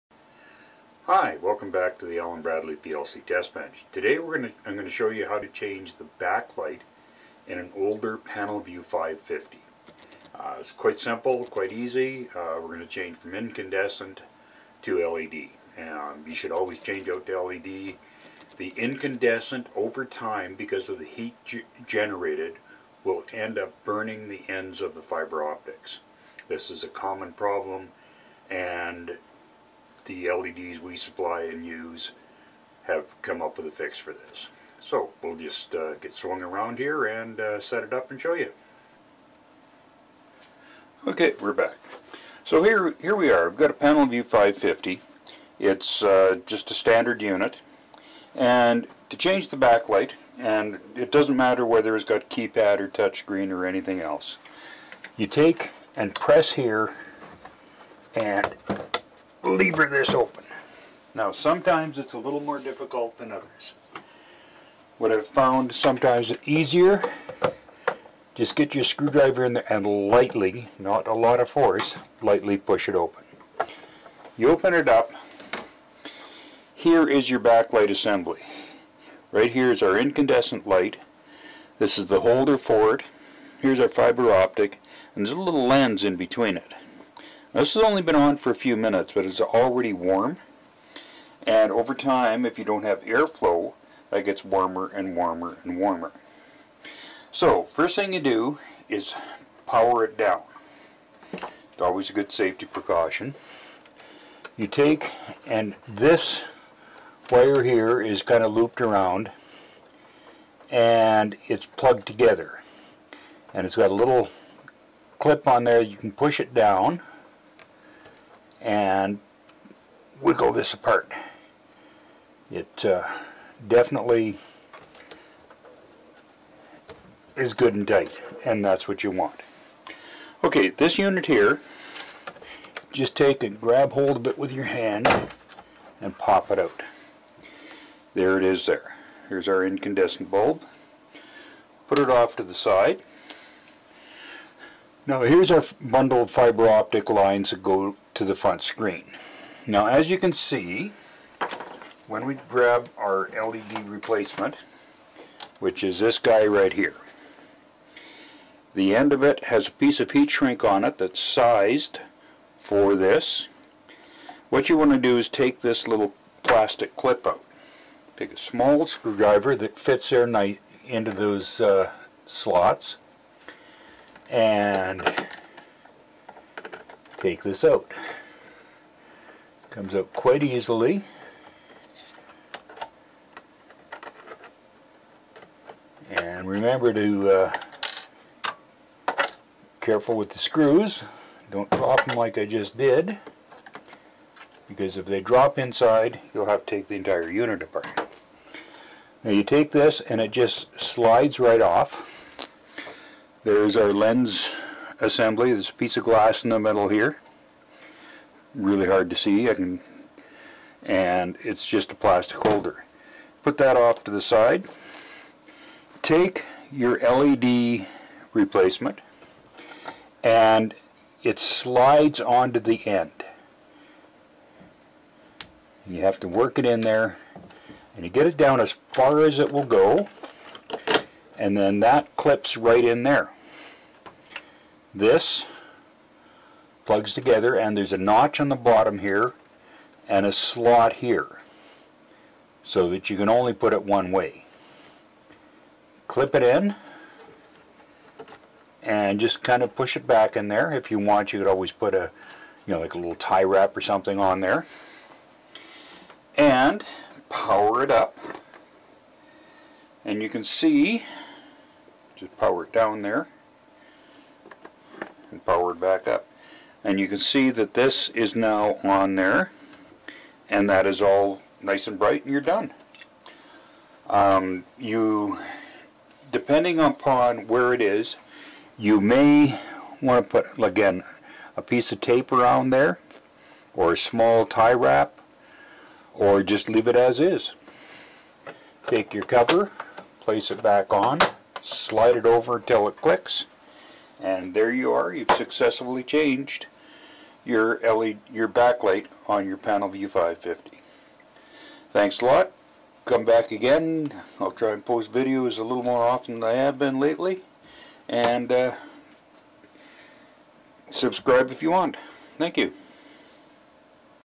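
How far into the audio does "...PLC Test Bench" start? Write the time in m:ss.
0:02.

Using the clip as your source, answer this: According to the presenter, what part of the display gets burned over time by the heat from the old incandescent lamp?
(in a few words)
ends of the fiber optics.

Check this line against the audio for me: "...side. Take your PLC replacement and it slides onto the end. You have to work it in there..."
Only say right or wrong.
wrong.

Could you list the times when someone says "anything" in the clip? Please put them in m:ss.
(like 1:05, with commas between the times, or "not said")
0:53.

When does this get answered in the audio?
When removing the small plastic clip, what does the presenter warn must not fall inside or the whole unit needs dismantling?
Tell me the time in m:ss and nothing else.
3:10.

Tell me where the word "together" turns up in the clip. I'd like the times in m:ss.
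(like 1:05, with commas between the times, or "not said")
1:52, 3:57.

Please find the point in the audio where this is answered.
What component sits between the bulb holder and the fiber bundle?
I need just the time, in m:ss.
1:25.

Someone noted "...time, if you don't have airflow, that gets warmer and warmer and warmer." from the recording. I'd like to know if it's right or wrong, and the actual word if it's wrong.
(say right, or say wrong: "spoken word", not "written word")
right.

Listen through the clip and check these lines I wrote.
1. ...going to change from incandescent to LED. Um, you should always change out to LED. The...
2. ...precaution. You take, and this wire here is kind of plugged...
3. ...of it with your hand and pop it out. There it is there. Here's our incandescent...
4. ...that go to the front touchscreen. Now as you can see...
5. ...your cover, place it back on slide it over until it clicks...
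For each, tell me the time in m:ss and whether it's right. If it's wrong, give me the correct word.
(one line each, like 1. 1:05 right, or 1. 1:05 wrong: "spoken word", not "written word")
1. 0:12 right
2. 1:42 wrong: "looped", not "plugged"
3. 2:14 right
4. 2:27 wrong: "screen", not "touchscreen"
5. 4:49 right.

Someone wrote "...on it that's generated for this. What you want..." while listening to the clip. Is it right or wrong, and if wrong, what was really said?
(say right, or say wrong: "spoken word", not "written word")
wrong: "sized", not "generated".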